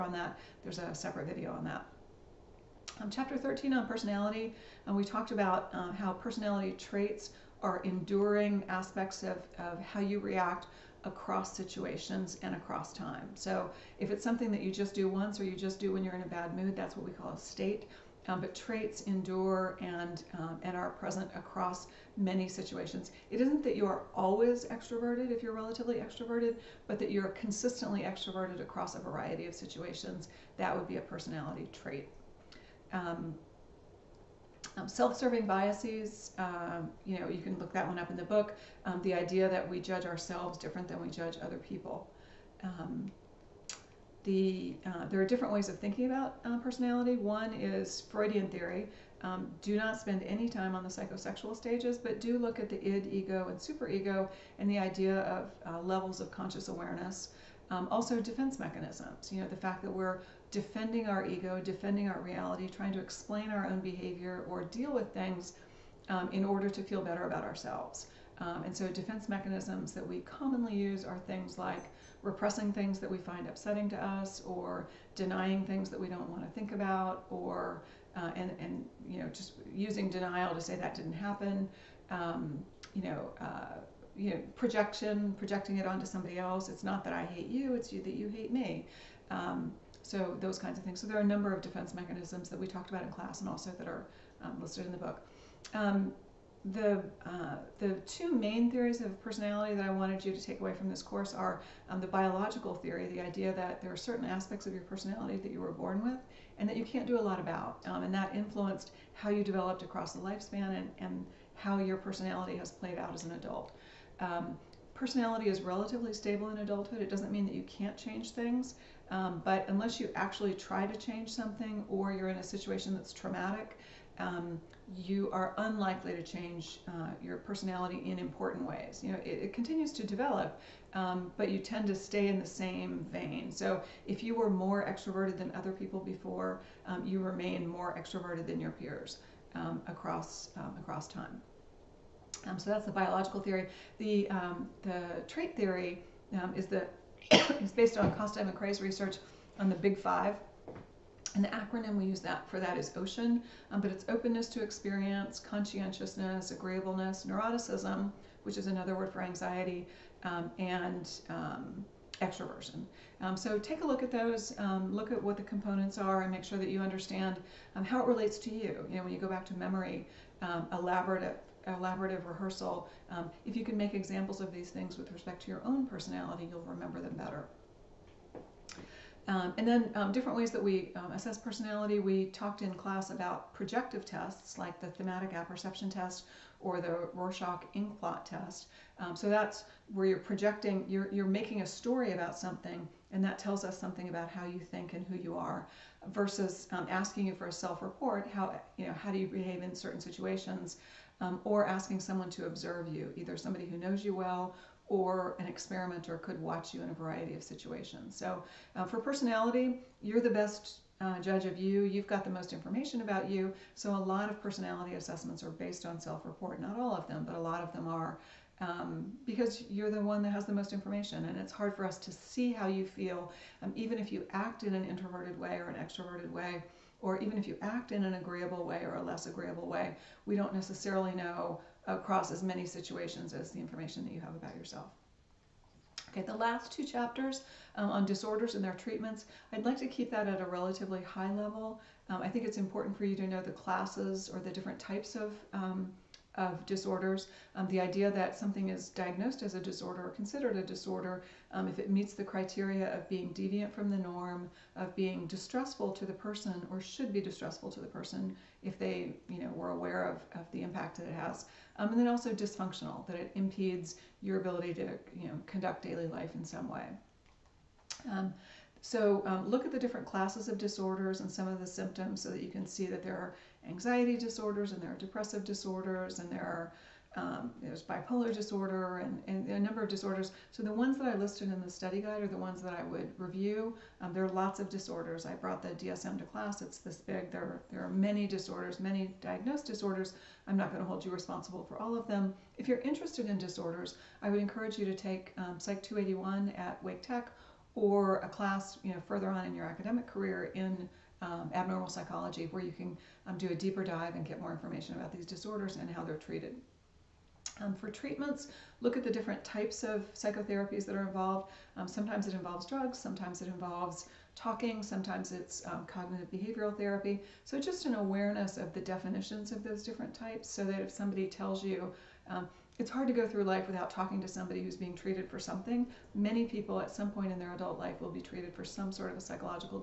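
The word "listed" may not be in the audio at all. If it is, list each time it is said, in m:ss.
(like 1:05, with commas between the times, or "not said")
1:34, 4:41.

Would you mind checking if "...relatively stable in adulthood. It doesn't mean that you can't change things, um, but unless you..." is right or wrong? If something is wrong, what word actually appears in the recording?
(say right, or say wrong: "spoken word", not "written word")
right.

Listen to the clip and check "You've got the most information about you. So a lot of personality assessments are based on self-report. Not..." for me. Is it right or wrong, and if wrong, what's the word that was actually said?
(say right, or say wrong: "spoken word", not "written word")
right.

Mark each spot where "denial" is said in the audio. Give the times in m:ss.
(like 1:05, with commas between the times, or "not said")
1:20.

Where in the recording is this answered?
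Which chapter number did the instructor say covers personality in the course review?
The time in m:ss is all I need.
0:03.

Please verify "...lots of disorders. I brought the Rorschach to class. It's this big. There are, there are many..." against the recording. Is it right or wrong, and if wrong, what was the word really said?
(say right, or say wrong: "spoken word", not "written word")
wrong: "DSM", not "Rorschach".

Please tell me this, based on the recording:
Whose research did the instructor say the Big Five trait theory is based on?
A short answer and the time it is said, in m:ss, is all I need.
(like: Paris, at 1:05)
Costa and McCrae, at 2:28.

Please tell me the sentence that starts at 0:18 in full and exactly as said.
Um, but traits endure and um, and are present across many situations.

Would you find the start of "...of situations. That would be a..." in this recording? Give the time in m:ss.
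0:29.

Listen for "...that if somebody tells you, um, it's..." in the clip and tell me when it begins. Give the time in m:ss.
5:20.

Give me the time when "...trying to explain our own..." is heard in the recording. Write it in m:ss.
1:02.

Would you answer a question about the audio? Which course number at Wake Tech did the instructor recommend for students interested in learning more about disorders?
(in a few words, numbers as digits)
Psych 281.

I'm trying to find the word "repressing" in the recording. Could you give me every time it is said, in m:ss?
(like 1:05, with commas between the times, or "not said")
1:12.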